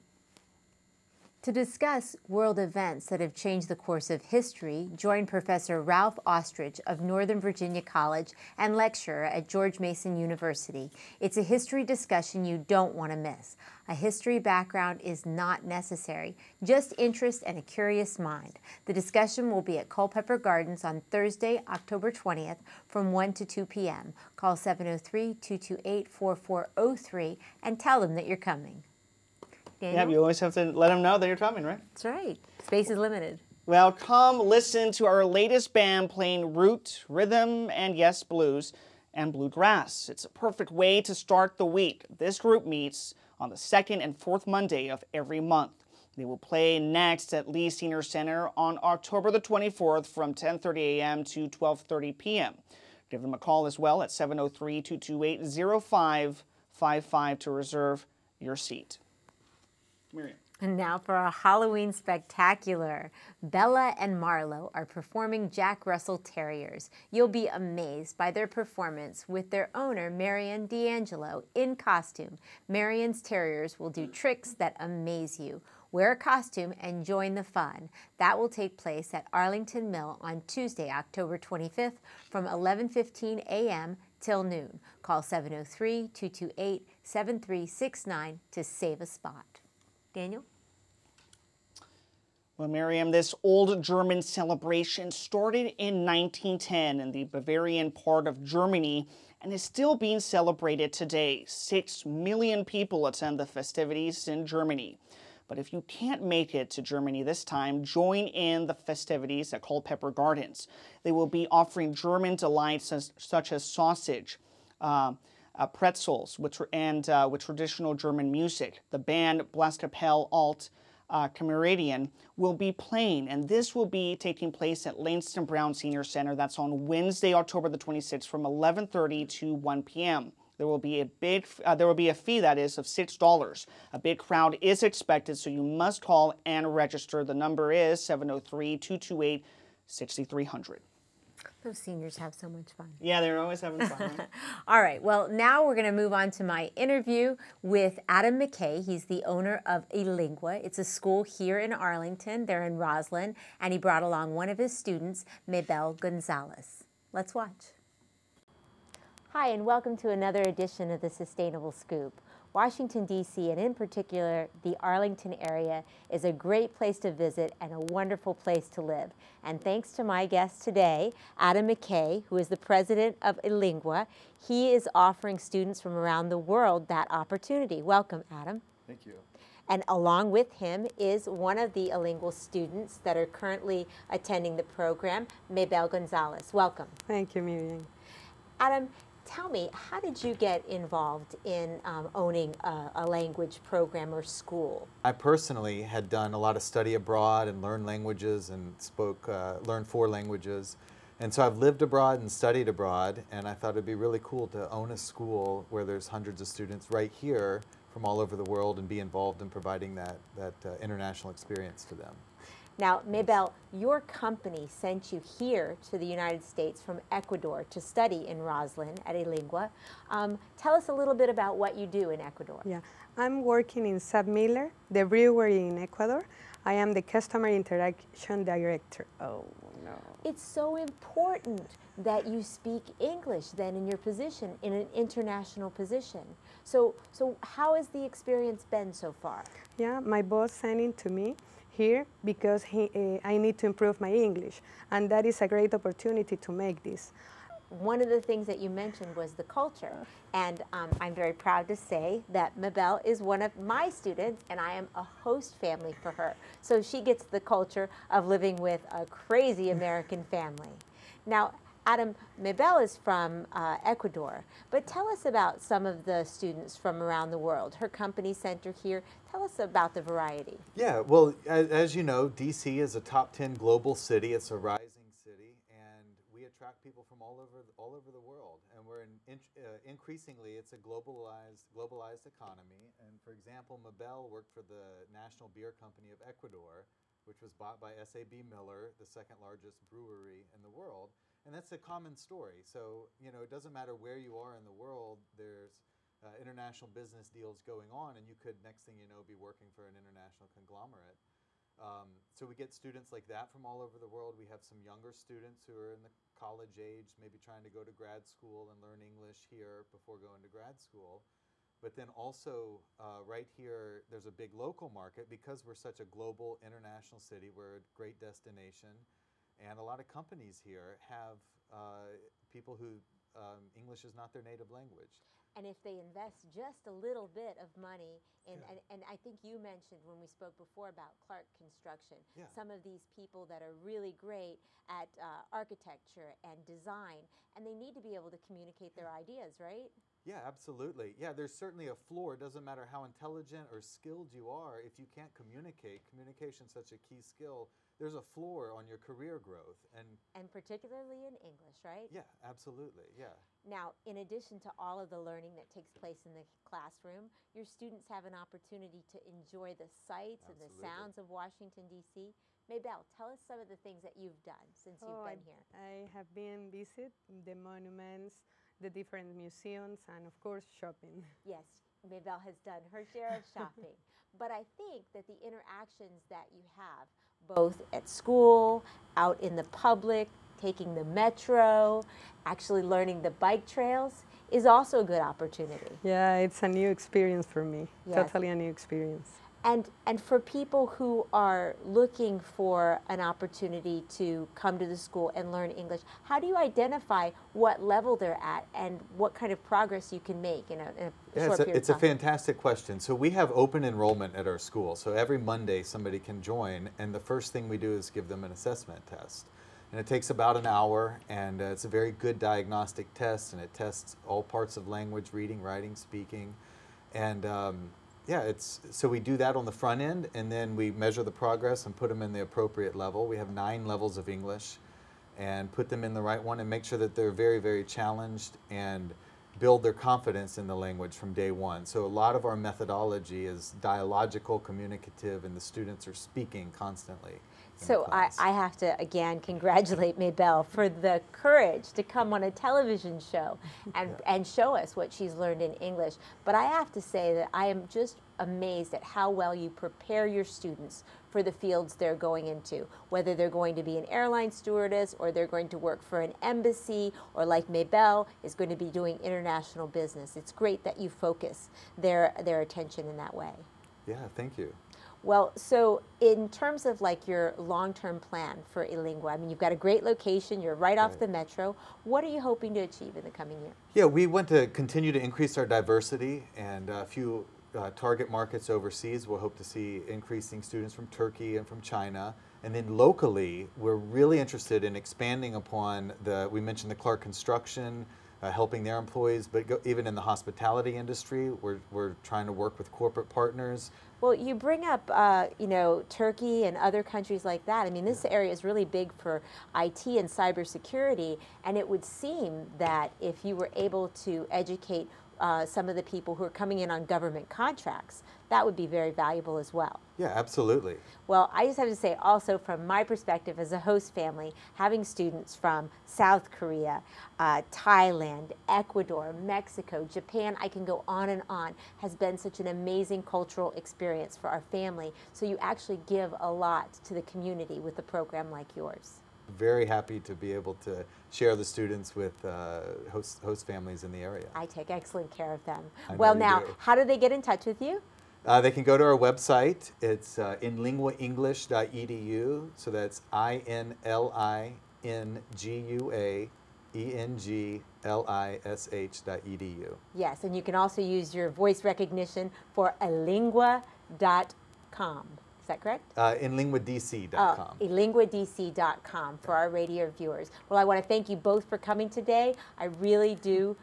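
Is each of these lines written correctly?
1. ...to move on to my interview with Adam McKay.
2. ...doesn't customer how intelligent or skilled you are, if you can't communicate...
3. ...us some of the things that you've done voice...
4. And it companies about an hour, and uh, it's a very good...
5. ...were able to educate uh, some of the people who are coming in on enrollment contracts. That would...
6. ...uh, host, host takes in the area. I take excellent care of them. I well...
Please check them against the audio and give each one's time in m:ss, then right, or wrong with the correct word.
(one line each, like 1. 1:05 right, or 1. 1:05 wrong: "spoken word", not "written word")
1. 2:25 right
2. 5:42 wrong: "matter", not "customer"
3. 6:03 wrong: "since", not "voice"
4. 6:49 wrong: "takes", not "companies"
5. 8:23 wrong: "government", not "enrollment"
6. 8:52 wrong: "families", not "takes".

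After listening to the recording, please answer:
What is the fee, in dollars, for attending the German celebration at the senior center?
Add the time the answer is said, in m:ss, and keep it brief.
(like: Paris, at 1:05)
$6, at 2:12.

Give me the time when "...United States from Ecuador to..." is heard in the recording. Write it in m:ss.
3:36.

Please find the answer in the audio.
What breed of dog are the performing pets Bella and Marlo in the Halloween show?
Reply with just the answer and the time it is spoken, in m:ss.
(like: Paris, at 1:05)
Jack Russell Terriers, at 1:05.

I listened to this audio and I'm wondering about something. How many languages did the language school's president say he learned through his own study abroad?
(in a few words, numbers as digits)
4.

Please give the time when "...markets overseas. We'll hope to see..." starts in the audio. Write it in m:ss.
7:58.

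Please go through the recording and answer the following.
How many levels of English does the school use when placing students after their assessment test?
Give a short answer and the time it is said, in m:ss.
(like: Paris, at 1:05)
9, at 7:03.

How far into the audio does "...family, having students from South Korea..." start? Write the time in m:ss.
8:34.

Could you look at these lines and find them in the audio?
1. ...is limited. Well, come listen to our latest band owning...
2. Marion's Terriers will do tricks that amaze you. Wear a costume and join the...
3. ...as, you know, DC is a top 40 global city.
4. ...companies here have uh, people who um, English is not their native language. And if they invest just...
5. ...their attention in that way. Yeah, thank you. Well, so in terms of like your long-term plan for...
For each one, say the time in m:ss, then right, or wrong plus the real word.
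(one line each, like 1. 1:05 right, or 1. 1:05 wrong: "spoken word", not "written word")
1. 0:32 wrong: "playing", not "owning"
2. 1:12 right
3. 4:31 wrong: "10", not "40"
4. 5:20 right
5. 7:42 right.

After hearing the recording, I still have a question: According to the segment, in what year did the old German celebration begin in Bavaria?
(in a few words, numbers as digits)
1910.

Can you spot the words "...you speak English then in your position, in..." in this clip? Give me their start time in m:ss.
3:52.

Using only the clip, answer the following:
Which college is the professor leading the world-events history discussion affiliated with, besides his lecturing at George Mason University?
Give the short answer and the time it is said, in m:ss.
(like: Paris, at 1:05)
Northern Virginia College, at 0:07.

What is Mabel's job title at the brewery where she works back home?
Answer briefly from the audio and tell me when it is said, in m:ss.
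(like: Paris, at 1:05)
customer interaction director, at 3:47.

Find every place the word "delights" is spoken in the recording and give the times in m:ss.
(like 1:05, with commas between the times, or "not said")
1:52.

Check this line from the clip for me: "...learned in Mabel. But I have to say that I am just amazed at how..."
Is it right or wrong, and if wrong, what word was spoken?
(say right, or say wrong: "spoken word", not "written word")
wrong: "English", not "Mabel".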